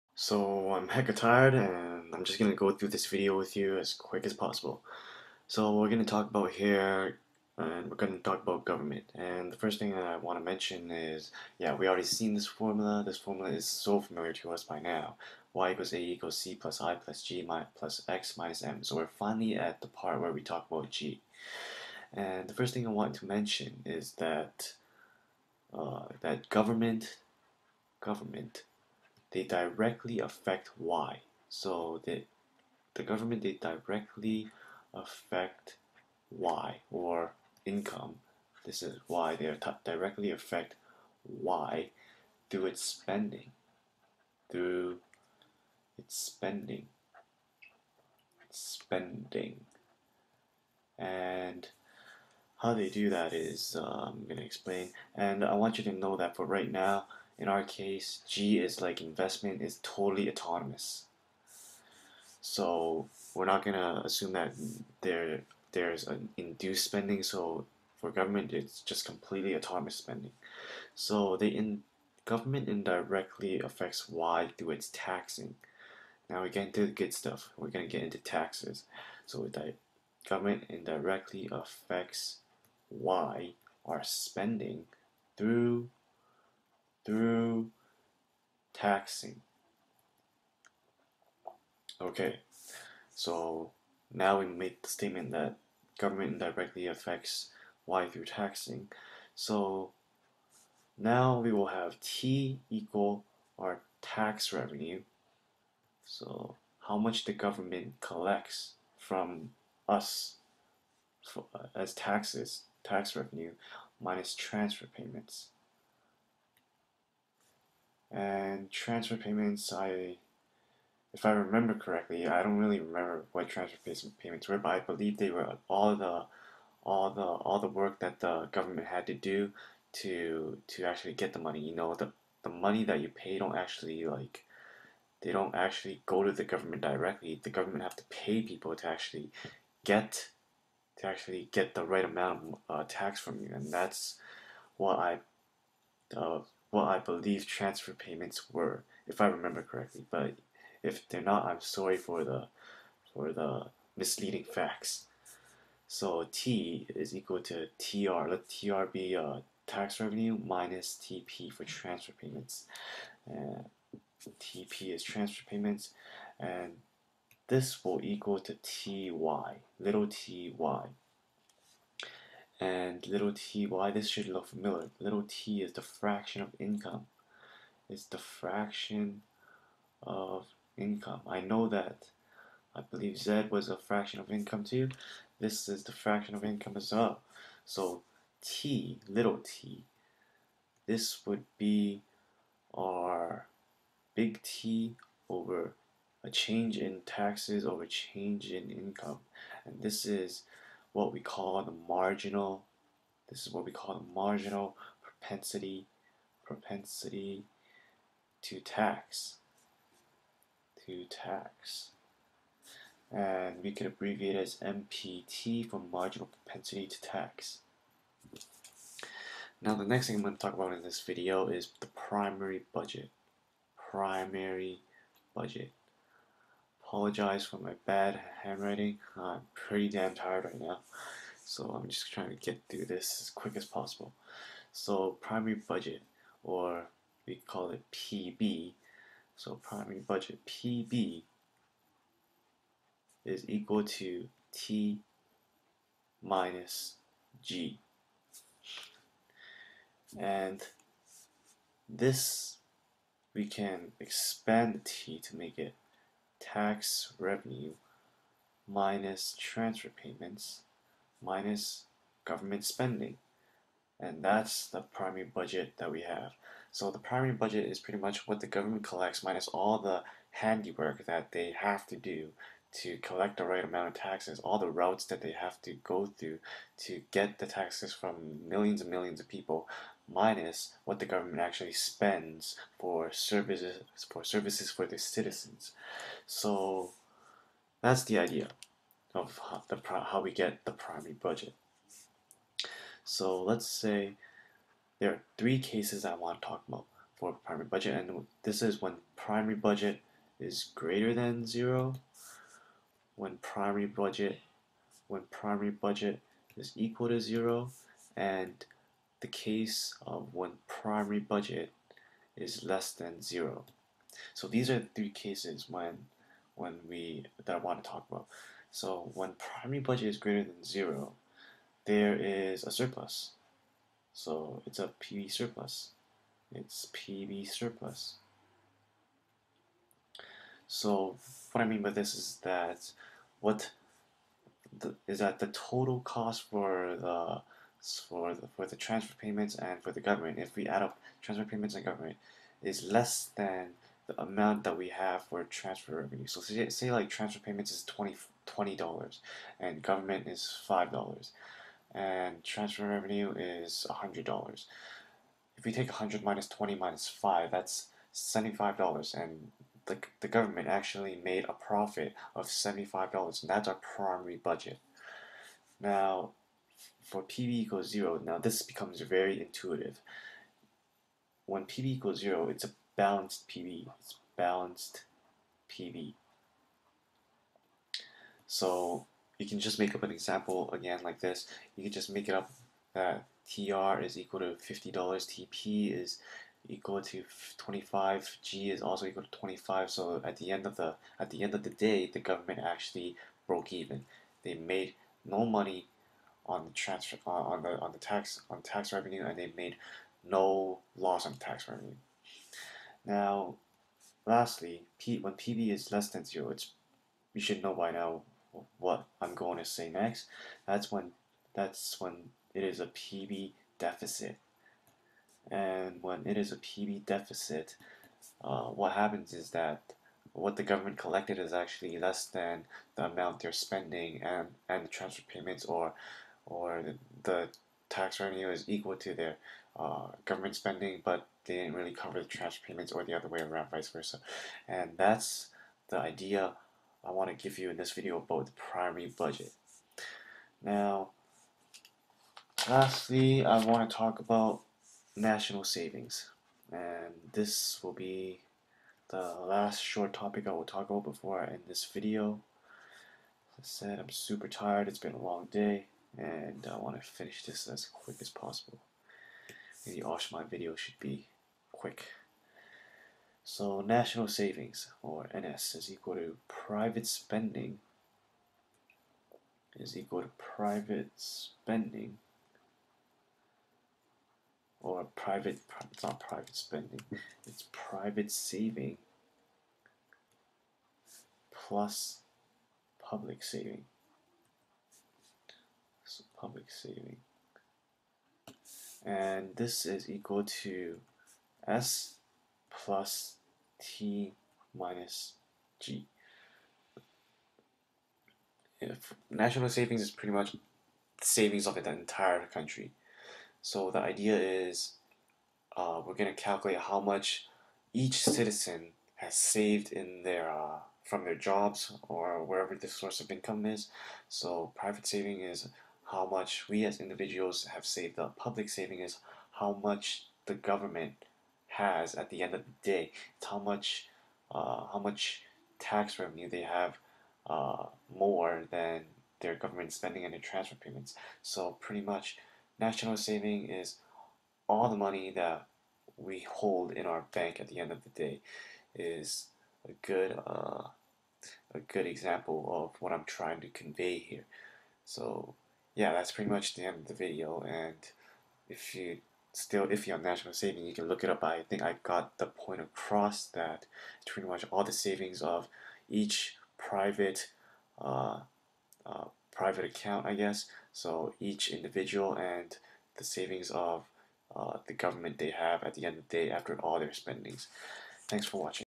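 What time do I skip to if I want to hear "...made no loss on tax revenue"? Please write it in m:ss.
6:39.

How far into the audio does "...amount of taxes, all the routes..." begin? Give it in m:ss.
4:33.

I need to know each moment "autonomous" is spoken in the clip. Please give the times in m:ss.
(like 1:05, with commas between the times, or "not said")
1:00, 1:09.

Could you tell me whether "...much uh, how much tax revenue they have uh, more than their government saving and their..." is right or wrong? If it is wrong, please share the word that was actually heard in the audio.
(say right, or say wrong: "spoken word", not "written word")
wrong: "spending", not "saving".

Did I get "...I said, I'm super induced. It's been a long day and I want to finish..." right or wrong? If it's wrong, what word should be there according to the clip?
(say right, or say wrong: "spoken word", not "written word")
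wrong: "tired", not "induced".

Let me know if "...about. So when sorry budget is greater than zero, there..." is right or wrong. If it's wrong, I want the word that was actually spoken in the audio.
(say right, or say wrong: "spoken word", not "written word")
wrong: "primary", not "sorry".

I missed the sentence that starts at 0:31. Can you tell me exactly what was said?
So the, the government, they directly affect Y or income.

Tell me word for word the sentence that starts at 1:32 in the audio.
Okay, so now we make the statement that government indirectly affects y through taxing.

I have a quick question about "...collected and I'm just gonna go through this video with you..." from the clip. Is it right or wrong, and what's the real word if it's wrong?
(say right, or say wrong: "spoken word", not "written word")
wrong: "tired", not "collected".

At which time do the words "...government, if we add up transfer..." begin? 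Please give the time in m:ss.
5:40.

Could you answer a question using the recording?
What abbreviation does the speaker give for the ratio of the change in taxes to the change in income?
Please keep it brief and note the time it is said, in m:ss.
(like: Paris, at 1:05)
MPT, at 3:34.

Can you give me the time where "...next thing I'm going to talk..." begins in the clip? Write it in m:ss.
3:39.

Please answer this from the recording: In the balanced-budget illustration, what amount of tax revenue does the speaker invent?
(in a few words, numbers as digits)
$50.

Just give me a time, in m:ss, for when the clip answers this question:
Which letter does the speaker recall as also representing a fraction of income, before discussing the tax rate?
3:03.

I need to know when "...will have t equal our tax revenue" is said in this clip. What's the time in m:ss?
1:41.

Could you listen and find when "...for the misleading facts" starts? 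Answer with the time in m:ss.
2:33.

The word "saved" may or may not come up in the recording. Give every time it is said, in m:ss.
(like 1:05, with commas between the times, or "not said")
8:29, 8:37.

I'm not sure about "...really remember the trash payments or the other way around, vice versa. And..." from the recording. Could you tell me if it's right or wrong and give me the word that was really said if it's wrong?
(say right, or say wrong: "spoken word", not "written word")
wrong: "cover", not "remember".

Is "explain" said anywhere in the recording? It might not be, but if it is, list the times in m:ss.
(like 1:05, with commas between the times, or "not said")
0:54.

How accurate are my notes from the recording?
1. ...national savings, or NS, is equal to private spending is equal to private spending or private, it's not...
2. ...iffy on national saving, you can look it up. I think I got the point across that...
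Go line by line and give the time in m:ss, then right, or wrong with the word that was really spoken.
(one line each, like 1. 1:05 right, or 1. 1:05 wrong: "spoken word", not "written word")
1. 7:43 right
2. 9:09 right.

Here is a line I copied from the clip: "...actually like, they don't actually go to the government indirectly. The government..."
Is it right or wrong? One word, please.
wrong.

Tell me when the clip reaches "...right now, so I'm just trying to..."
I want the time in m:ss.
3:50.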